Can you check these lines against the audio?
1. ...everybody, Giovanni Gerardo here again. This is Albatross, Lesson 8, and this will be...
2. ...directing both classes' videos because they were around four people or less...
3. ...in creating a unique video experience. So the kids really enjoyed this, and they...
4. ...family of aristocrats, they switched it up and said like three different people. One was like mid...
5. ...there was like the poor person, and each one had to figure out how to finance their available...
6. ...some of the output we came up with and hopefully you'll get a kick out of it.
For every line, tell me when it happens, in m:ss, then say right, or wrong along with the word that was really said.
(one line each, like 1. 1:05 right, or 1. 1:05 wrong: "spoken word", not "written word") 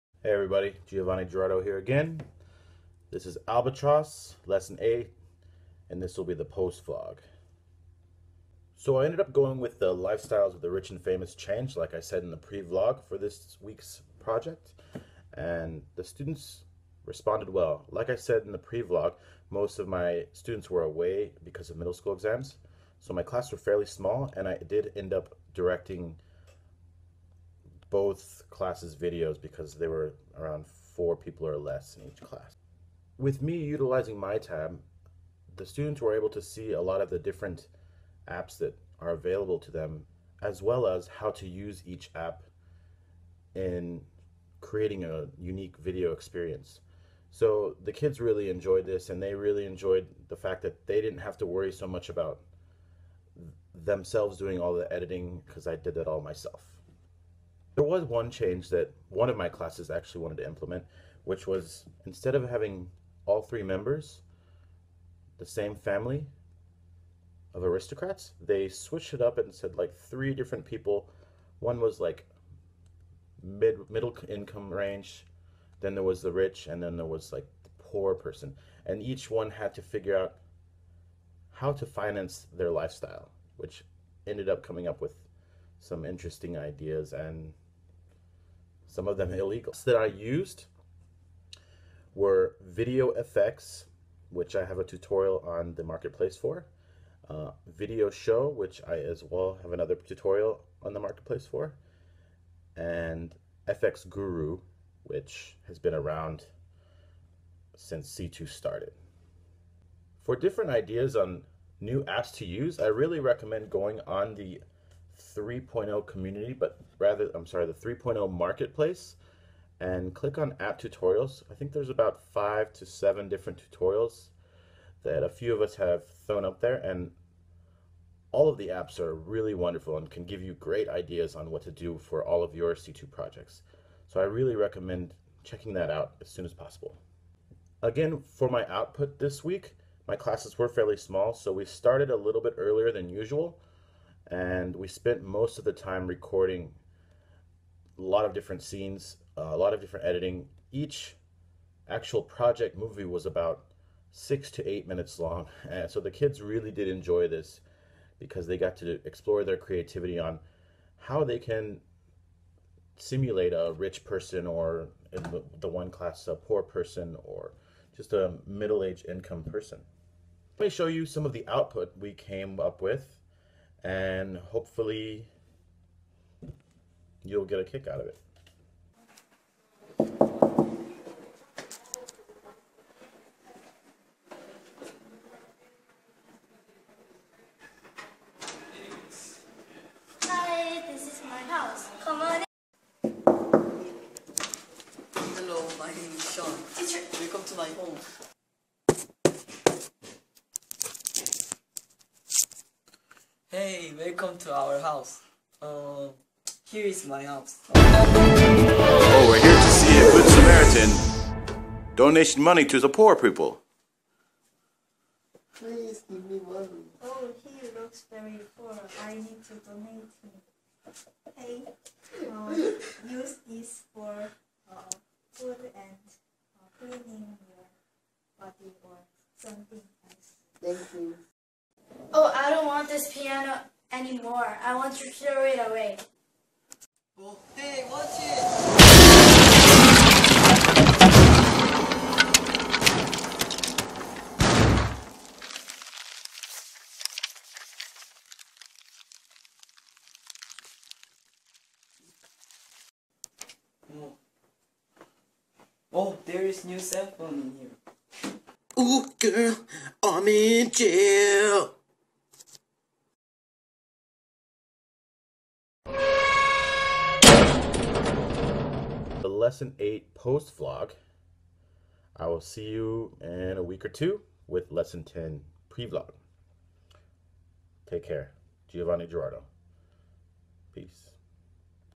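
1. 0:00 right
2. 0:25 right
3. 0:43 right
4. 1:05 right
5. 1:16 wrong: "lifestyle", not "available"
6. 2:51 right.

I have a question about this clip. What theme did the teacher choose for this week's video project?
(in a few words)
Lifestyles of the Rich and Famous.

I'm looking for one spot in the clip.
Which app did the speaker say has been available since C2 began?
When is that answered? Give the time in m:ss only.
1:43.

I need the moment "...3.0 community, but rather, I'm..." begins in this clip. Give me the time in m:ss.
1:55.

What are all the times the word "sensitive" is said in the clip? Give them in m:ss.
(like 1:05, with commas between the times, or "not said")
not said.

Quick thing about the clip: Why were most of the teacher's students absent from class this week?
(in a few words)
Middle school exams.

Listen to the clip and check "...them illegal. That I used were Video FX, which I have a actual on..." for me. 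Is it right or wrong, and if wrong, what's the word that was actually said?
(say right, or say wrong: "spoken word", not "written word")
wrong: "tutorial", not "actual".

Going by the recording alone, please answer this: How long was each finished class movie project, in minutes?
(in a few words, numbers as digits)
6 to 8 minutes.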